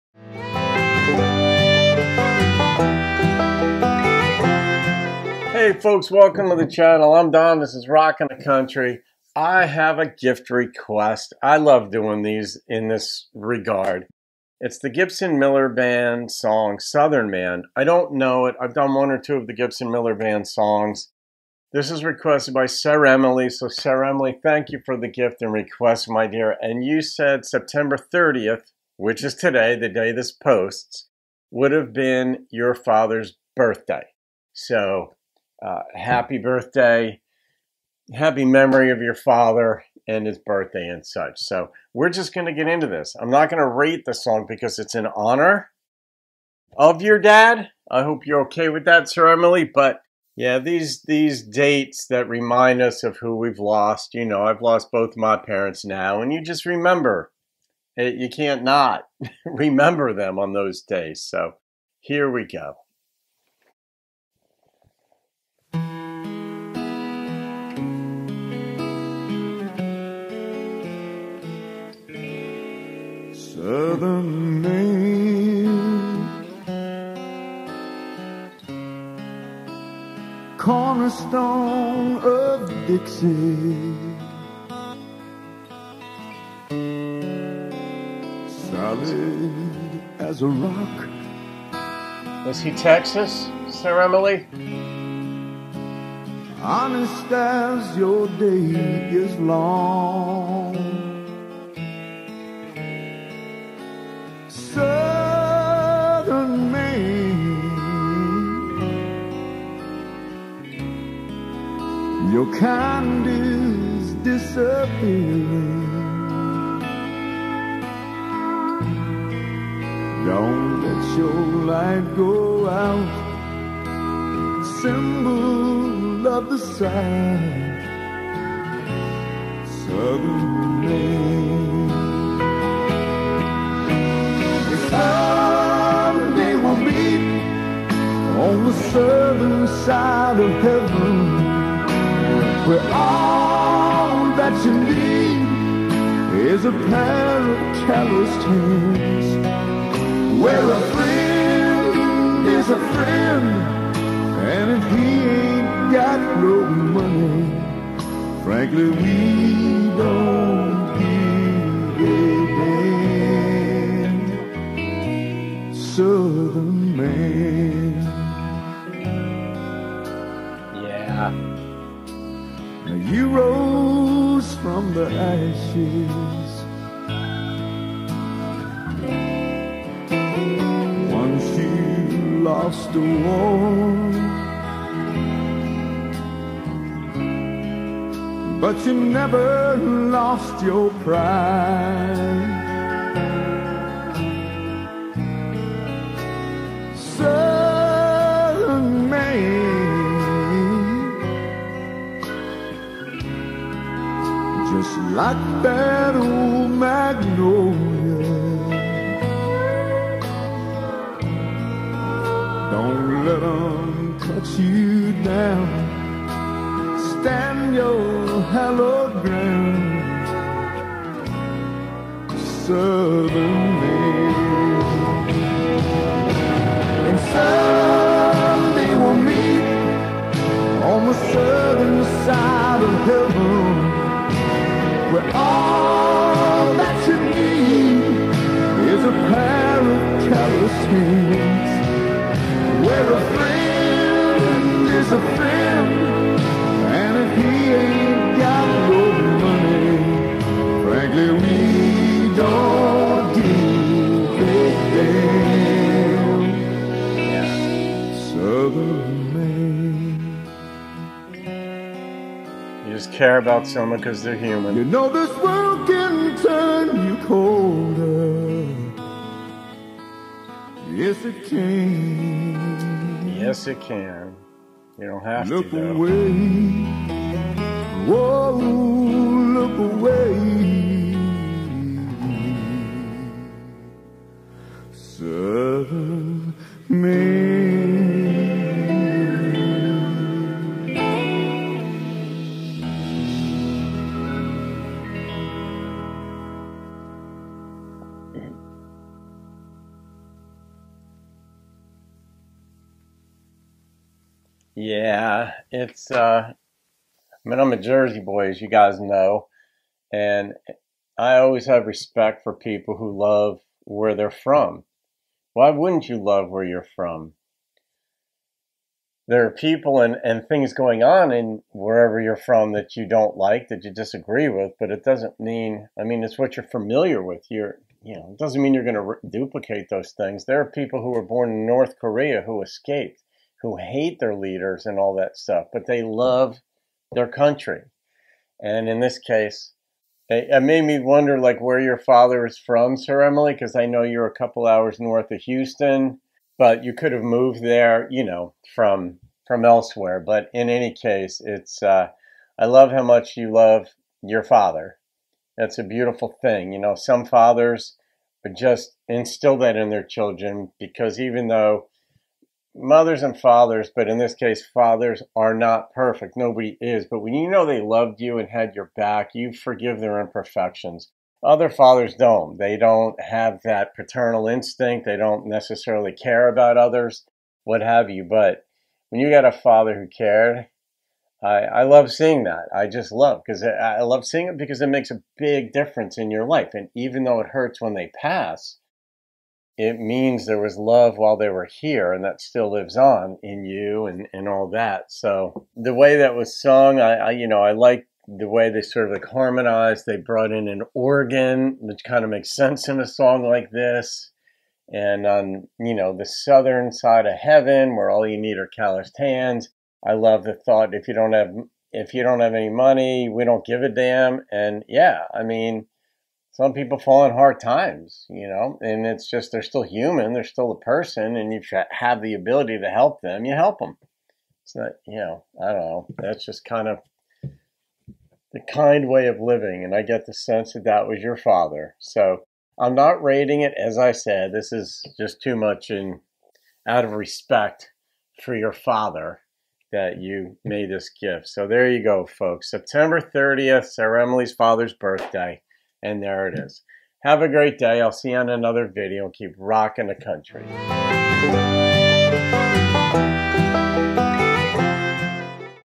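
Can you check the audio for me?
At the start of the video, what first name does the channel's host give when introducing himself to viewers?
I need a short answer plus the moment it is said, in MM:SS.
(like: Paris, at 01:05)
Don, at 00:07.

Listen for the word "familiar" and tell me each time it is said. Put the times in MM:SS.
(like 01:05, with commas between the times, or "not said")
05:26.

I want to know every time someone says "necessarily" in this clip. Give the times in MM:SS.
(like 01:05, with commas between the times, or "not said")
06:15.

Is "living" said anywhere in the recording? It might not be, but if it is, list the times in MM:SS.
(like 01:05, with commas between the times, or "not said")
07:09.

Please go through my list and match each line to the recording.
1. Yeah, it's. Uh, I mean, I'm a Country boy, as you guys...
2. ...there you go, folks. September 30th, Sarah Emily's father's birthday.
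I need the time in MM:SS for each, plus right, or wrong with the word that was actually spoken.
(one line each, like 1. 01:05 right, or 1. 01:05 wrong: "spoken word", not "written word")
1. 05:04 wrong: "Jersey", not "Country"
2. 07:21 right.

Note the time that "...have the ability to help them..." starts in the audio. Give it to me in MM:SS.
07:01.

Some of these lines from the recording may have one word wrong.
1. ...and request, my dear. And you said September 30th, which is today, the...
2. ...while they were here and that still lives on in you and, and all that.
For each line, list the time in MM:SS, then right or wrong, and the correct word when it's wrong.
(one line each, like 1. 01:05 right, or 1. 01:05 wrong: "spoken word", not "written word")
1. 00:25 right
2. 06:31 right.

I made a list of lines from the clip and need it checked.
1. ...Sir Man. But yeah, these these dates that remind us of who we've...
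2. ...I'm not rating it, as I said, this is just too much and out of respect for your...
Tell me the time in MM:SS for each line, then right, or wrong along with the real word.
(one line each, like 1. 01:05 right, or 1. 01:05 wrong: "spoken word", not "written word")
1. 00:49 wrong: "Emily", not "Man"
2. 07:12 right.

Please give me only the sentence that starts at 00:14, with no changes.
It's the Gibson Miller Band song, Southern Man.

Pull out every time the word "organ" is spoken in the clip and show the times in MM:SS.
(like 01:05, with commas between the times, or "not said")
06:40.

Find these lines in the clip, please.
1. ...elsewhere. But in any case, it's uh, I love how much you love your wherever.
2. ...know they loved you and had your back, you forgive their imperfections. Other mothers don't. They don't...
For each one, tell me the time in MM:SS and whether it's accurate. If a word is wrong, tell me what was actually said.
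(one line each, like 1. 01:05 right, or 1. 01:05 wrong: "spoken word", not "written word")
1. 05:49 wrong: "father", not "wherever"
2. 06:07 wrong: "fathers", not "mothers".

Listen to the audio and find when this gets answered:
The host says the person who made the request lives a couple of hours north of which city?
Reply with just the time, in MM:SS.
05:45.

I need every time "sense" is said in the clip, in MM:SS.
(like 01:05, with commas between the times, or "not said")
06:42, 07:10.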